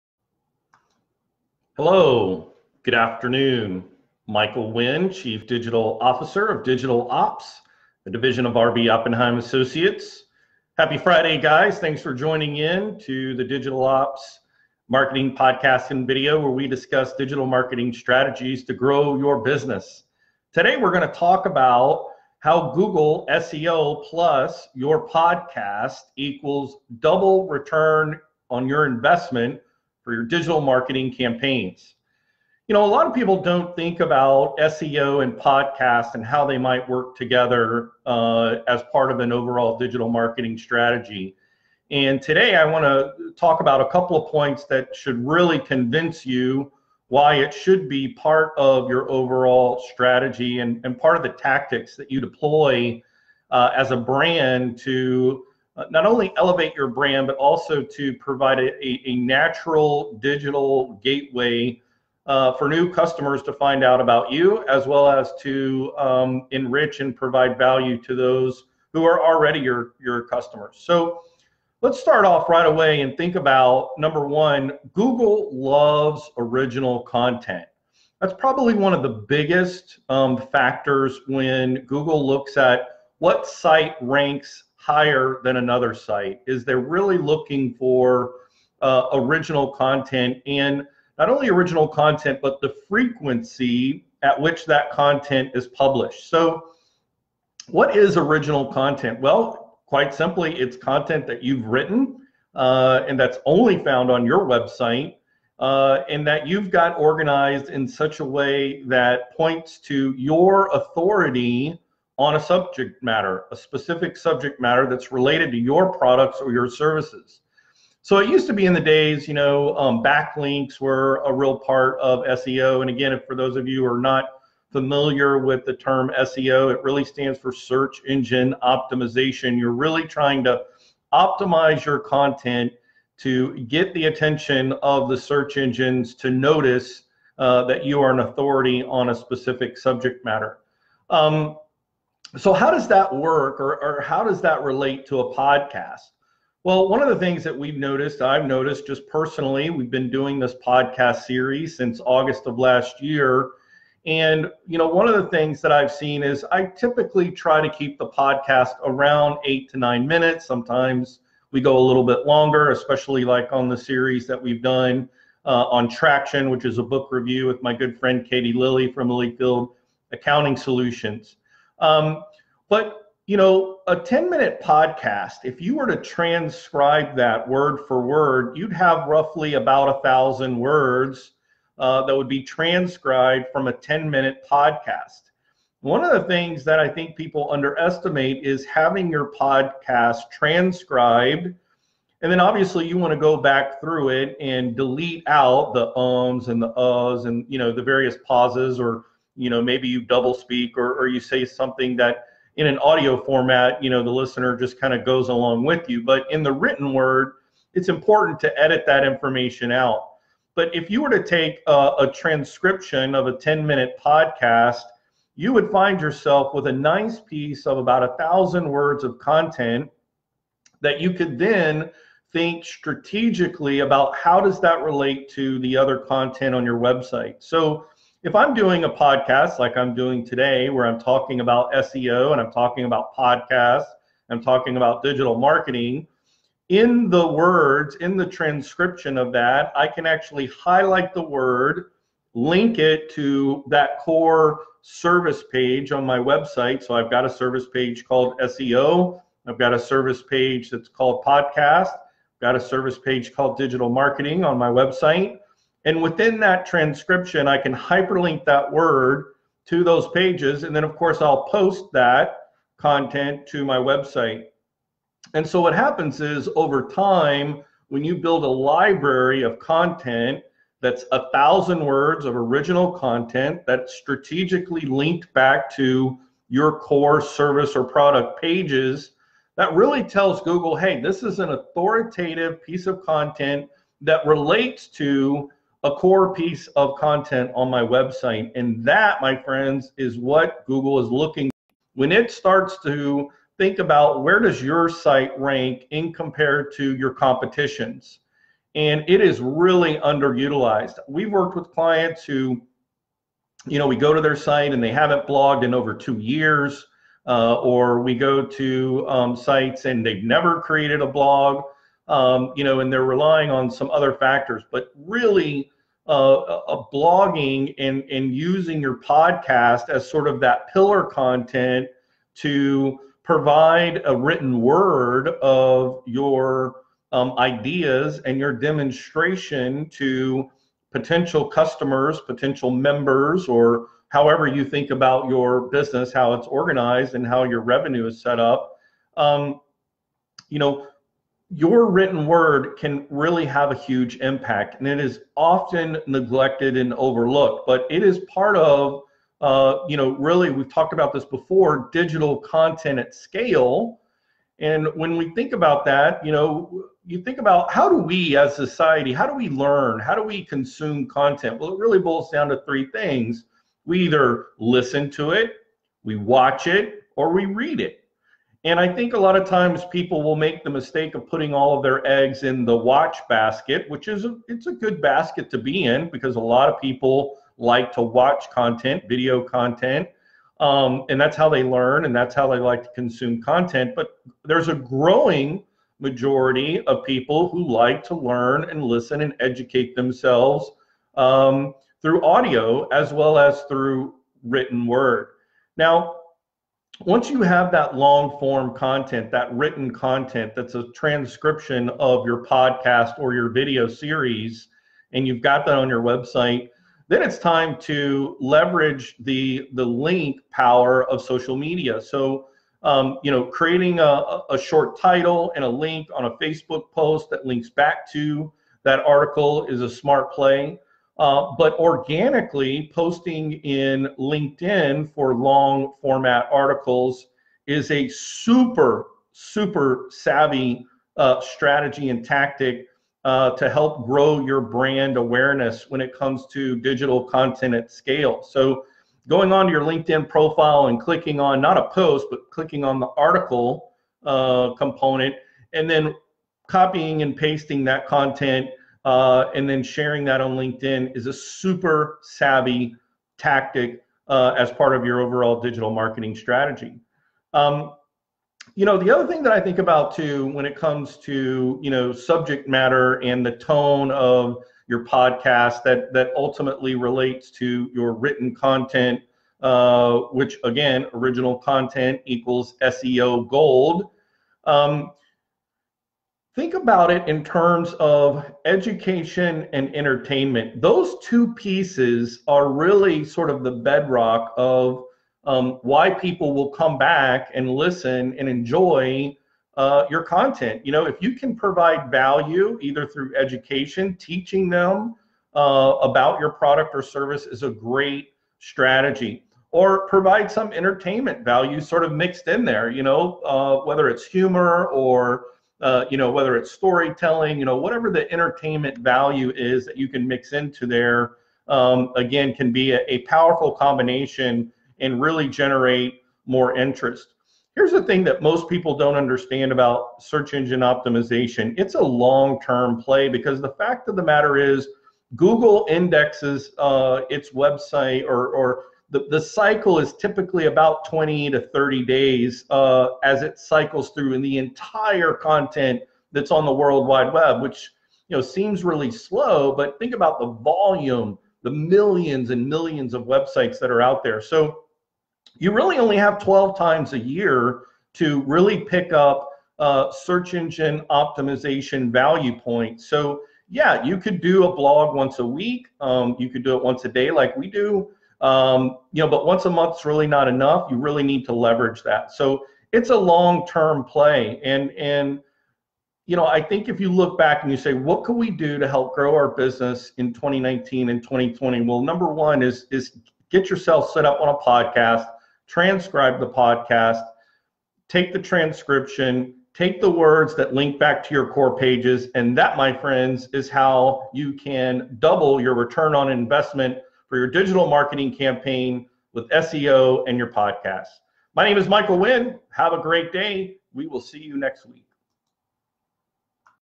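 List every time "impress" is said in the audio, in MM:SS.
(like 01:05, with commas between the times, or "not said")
not said.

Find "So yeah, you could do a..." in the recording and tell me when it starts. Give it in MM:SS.
09:13.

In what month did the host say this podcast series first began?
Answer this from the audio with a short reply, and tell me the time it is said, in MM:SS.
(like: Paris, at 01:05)
August, at 02:32.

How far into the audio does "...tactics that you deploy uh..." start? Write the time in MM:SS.
00:51.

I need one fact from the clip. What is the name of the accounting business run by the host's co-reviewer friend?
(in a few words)
Lillyfield Accounting Solutions.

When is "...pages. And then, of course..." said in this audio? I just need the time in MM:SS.
04:20.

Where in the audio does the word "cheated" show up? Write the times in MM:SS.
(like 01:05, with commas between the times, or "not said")
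not said.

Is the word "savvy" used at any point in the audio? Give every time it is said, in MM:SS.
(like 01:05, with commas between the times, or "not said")
07:10, 07:32.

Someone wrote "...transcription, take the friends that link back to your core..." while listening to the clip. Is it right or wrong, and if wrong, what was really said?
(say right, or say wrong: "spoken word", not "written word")
wrong: "words", not "friends".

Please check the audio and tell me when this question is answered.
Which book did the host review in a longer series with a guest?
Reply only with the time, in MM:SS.
02:45.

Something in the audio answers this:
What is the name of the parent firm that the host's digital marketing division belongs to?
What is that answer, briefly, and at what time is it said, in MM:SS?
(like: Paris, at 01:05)
RB Oppenheim Associates, at 00:08.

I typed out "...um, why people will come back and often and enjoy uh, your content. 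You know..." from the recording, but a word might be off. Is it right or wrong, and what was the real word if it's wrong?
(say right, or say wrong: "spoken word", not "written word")
wrong: "listen", not "often".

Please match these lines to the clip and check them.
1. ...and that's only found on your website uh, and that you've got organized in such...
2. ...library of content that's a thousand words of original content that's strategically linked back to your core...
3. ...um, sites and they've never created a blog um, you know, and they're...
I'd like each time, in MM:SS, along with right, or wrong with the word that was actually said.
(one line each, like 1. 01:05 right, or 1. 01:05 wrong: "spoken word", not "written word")
1. 01:43 right
2. 04:28 right
3. 05:09 right.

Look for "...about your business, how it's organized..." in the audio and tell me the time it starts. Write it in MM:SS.
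05:34.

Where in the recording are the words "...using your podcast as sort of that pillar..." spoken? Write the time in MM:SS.
05:18.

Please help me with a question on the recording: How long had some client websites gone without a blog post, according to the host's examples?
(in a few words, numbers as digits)
2 years.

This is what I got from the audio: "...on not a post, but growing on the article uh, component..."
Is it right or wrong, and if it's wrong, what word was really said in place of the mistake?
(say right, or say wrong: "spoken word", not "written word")
wrong: "clicking", not "growing".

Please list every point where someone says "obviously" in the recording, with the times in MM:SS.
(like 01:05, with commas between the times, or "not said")
03:12.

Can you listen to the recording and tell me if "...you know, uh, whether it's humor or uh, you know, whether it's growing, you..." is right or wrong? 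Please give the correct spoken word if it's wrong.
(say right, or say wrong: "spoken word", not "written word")
wrong: "storytelling", not "growing".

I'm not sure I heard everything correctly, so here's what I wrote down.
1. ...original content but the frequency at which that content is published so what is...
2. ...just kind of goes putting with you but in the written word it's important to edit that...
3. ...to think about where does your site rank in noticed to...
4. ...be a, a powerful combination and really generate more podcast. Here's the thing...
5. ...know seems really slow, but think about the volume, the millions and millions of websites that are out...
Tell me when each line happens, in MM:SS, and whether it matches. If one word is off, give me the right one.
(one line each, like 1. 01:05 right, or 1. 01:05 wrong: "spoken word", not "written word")
1. 01:31 right
2. 03:24 wrong: "along", not "putting"
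3. 04:52 wrong: "compared", not "noticed"
4. 08:32 wrong: "interest", not "podcast"
5. 08:58 right.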